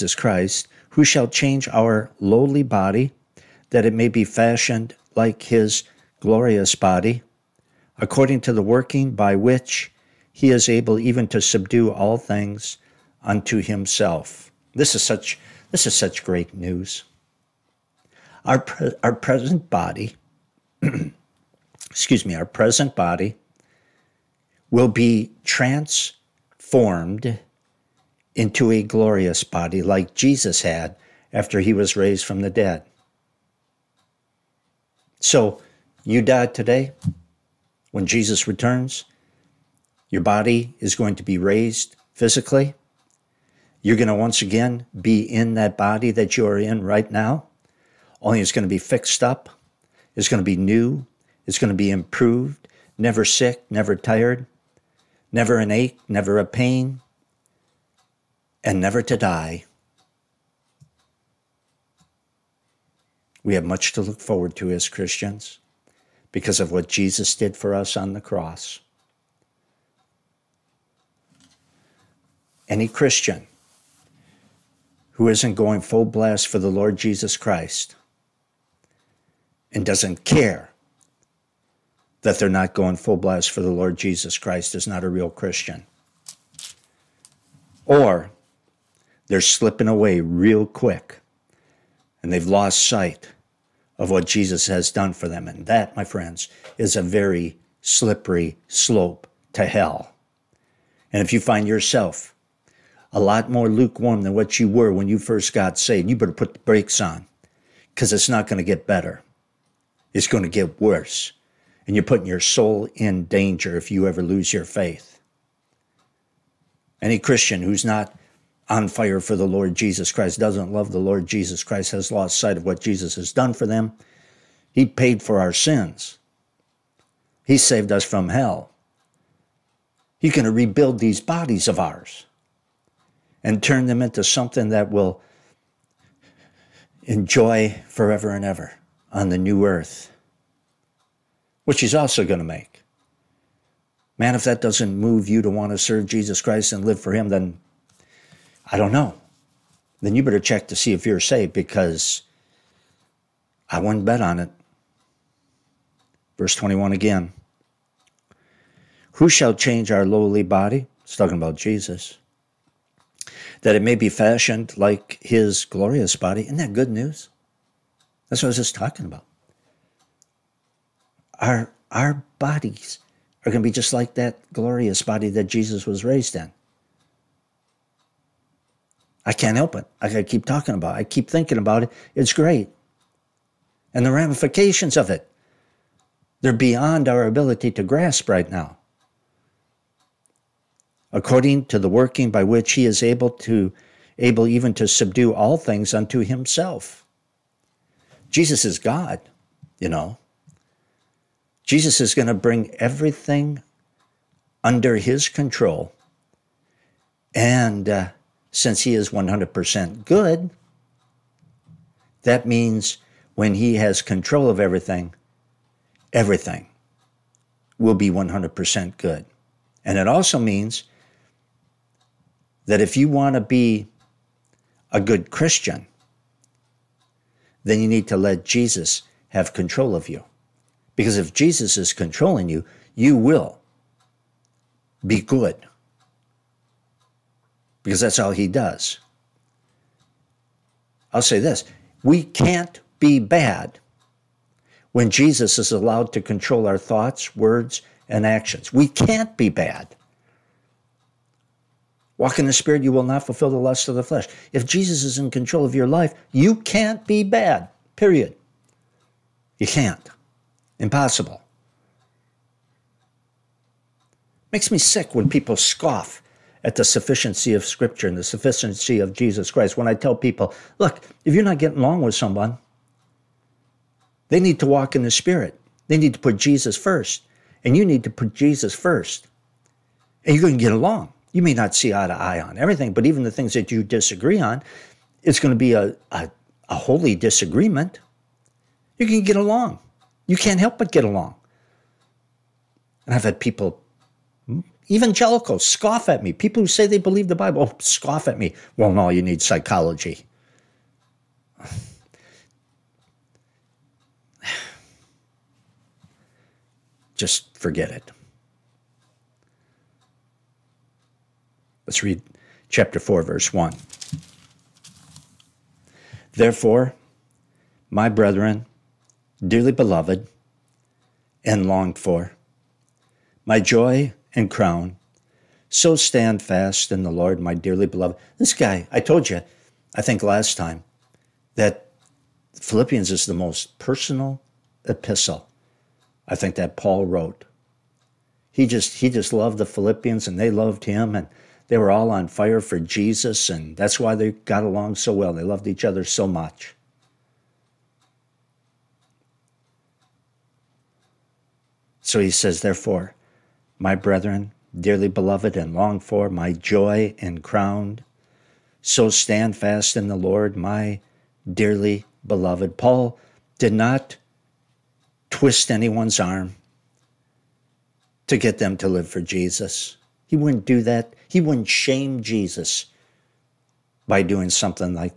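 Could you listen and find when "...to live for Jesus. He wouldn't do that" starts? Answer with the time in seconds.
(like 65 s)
368 s.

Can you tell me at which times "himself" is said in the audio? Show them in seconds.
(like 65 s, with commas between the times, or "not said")
13 s, 196 s.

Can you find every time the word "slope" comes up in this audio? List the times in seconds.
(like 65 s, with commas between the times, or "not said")
98 s.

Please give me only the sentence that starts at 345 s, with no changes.
They loved each other so much.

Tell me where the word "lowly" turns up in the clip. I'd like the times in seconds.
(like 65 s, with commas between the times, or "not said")
2 s, 160 s.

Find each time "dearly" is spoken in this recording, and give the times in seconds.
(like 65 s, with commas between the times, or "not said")
319 s, 327 s, 354 s, 361 s.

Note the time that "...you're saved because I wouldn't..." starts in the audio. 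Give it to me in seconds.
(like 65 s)
151 s.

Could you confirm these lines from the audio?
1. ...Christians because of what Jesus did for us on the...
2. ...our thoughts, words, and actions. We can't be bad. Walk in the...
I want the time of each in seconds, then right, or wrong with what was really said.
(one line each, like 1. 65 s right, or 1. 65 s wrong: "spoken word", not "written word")
1. 64 s right
2. 246 s right.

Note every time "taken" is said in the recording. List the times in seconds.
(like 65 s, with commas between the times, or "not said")
not said.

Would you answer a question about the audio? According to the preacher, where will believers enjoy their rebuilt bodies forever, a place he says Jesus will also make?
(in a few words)
the new earth.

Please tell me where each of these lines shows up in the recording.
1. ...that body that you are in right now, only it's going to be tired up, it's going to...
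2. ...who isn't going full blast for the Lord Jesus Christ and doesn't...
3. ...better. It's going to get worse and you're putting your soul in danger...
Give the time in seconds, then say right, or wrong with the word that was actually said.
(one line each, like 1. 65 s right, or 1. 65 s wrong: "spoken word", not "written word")
1. 45 s wrong: "fixed", not "tired"
2. 75 s right
3. 108 s right.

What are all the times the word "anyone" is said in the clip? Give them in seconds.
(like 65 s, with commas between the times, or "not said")
365 s.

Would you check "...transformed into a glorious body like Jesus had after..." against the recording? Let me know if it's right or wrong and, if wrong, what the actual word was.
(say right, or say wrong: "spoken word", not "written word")
right.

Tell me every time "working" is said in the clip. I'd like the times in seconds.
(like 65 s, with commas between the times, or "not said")
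8 s, 191 s.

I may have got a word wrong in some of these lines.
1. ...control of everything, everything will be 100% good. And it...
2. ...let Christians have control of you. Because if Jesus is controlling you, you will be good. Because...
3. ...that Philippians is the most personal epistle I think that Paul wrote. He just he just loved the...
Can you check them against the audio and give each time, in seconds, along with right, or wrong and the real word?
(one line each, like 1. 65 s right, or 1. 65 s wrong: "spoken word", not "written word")
1. 213 s right
2. 228 s wrong: "Jesus", not "Christians"
3. 331 s right.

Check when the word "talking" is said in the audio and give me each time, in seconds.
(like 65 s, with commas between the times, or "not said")
161 s, 168 s, 180 s.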